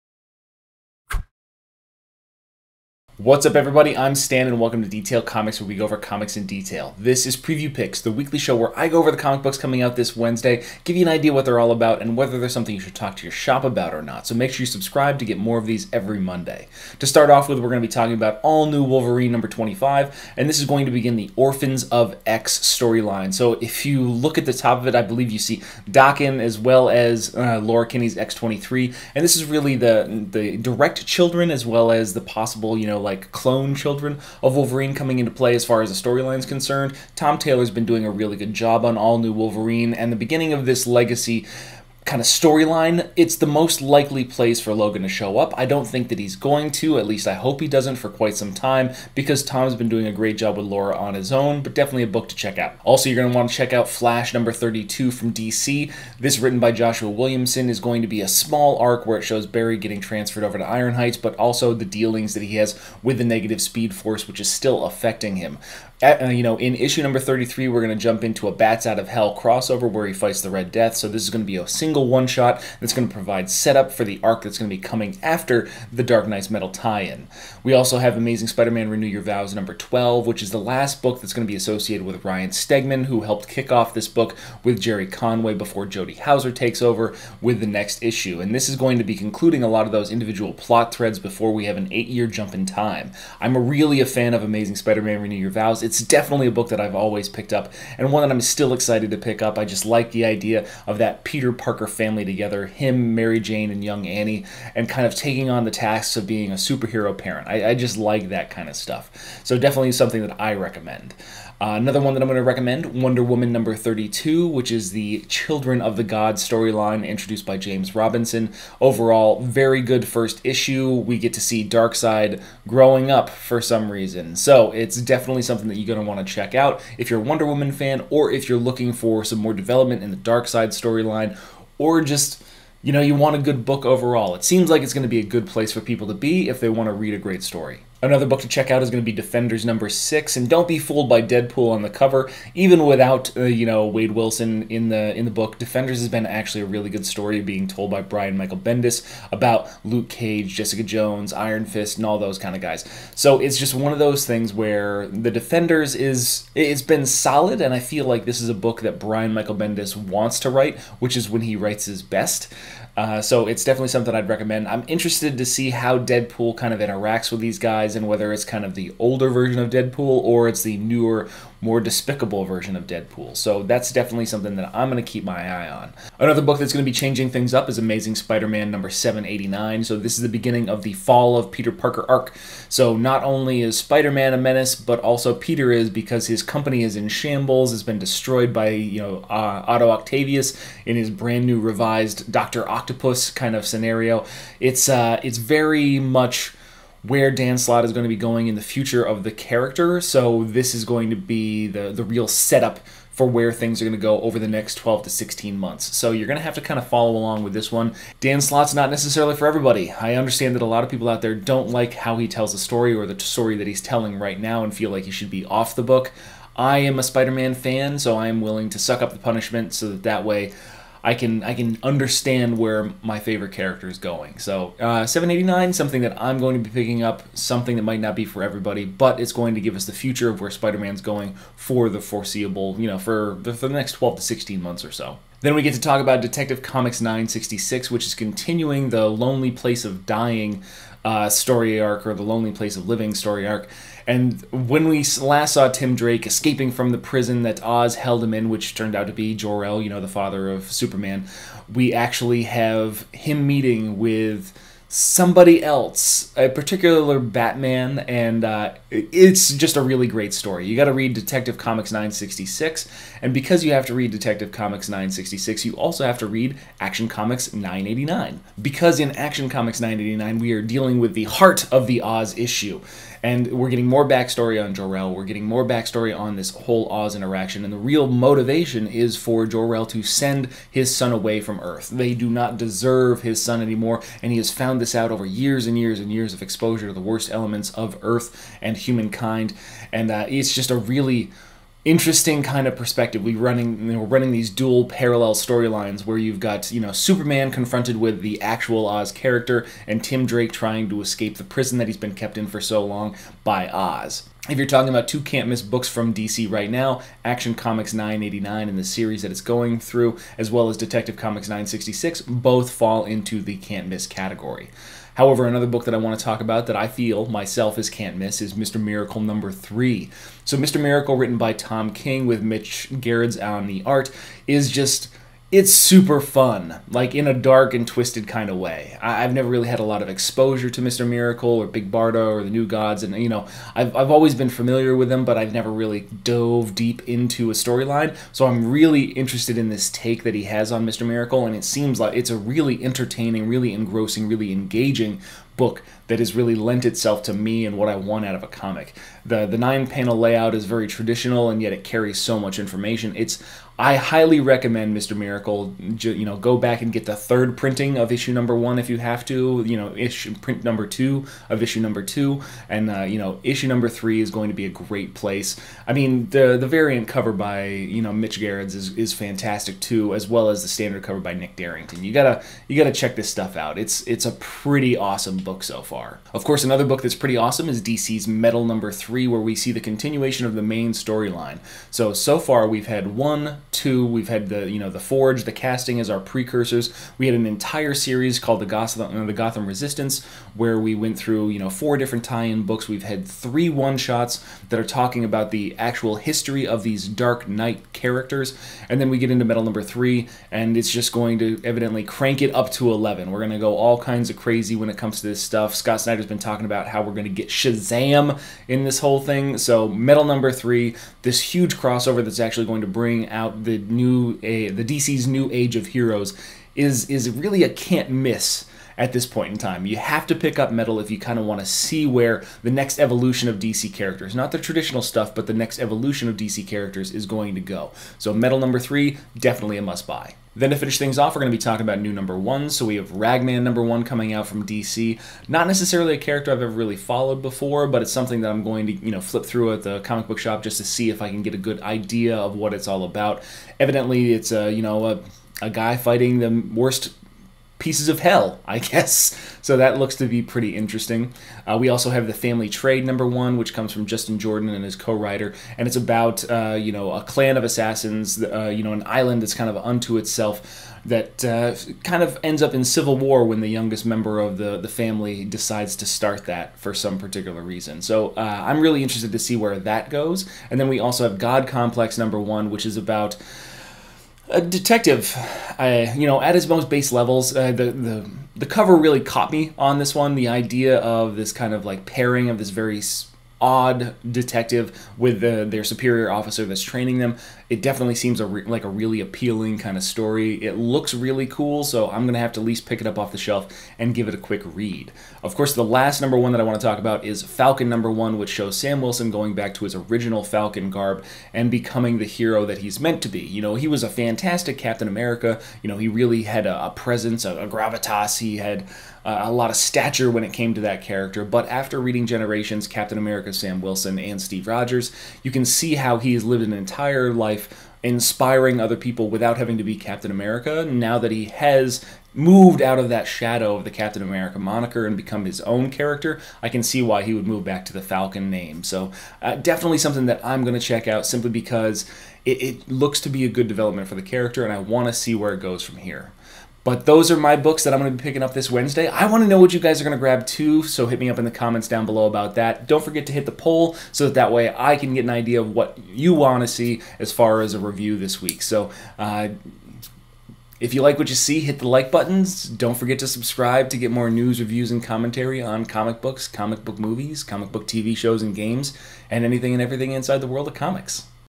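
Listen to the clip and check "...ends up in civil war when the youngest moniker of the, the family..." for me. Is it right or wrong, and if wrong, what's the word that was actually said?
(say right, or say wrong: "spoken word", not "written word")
wrong: "member", not "moniker".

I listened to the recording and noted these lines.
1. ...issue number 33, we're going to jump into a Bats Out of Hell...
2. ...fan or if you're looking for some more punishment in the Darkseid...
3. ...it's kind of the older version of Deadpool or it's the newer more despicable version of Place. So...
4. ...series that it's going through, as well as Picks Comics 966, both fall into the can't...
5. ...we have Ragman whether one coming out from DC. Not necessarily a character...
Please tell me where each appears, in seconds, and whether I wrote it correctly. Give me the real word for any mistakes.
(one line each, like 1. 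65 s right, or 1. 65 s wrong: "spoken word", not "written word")
1. 66 s right
2. 127 s wrong: "development", not "punishment"
3. 168 s wrong: "Deadpool", not "Place"
4. 308 s wrong: "Detective", not "Picks"
5. 432 s wrong: "number", not "whether".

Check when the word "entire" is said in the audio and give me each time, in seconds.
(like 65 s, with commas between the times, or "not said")
387 s, 516 s.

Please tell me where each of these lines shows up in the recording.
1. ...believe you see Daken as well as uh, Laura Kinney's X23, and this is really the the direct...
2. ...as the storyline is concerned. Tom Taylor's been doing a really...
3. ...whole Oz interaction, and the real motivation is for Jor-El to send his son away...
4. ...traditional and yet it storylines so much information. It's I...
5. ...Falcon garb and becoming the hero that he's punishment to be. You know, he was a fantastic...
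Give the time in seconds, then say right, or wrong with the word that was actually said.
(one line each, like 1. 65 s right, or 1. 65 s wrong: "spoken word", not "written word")
1. 25 s right
2. 35 s right
3. 276 s right
4. 350 s wrong: "carries", not "storylines"
5. 500 s wrong: "meant", not "punishment".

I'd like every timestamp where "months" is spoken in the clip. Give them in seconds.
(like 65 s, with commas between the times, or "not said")
205 s, 234 s.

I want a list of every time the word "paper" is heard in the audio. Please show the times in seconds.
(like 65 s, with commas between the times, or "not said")
not said.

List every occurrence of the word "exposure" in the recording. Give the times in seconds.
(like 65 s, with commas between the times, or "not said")
286 s, 330 s.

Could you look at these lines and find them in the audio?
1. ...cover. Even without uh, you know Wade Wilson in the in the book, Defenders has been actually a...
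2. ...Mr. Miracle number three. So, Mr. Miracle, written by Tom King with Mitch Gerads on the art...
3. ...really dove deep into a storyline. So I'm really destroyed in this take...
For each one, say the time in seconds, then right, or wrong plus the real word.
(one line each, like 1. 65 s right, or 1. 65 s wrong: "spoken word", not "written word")
1. 141 s right
2. 318 s right
3. 335 s wrong: "interested", not "destroyed".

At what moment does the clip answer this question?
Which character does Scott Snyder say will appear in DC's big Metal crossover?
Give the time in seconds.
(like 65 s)
407 s.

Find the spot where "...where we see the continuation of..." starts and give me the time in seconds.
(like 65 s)
379 s.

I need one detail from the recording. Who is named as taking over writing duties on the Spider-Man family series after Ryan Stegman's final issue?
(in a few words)
Jody Houser.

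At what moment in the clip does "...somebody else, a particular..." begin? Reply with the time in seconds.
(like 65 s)
254 s.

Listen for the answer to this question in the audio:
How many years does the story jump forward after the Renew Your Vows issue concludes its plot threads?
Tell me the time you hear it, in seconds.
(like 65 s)
91 s.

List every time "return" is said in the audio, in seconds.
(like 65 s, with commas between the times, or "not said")
not said.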